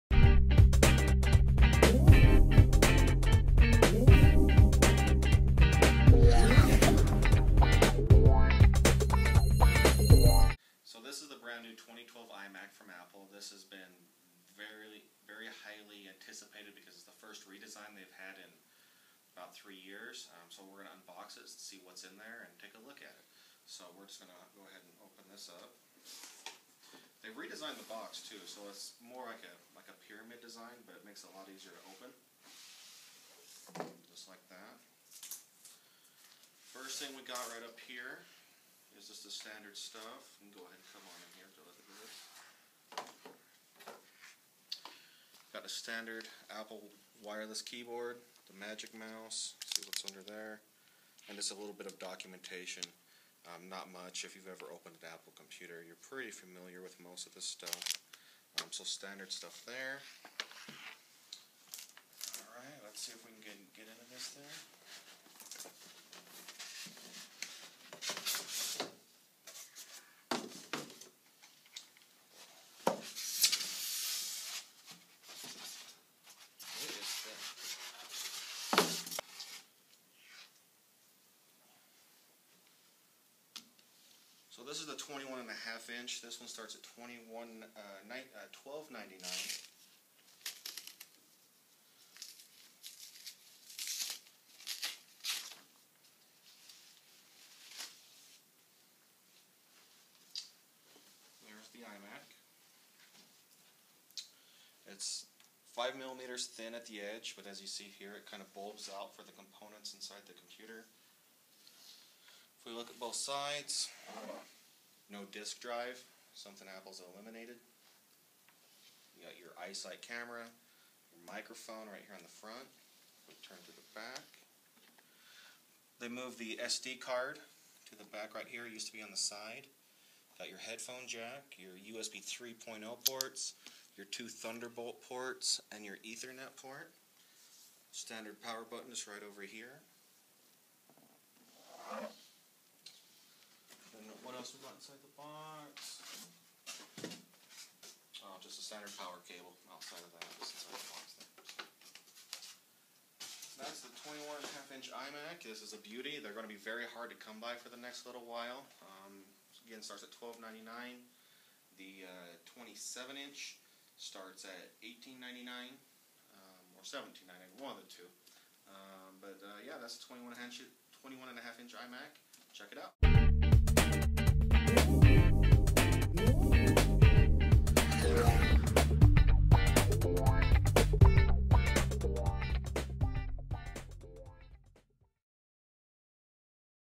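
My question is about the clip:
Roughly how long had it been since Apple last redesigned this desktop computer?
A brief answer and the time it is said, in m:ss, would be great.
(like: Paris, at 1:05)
about 3 years, at 0:19.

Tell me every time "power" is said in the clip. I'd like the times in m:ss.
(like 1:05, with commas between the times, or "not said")
2:18, 2:28.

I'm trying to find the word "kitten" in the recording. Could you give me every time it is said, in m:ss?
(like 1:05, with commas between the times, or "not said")
not said.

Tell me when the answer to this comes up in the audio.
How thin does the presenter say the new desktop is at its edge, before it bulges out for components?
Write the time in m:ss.
1:45.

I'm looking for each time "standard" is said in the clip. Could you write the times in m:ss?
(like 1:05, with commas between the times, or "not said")
0:39, 0:45, 0:58, 2:17, 2:28.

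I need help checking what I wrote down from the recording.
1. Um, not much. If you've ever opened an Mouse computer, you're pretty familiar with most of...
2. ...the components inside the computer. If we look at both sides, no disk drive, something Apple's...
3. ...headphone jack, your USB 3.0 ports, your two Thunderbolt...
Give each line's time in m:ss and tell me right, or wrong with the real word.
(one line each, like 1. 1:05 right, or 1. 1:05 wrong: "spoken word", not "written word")
1. 0:53 wrong: "Apple", not "Mouse"
2. 1:49 right
3. 2:10 right.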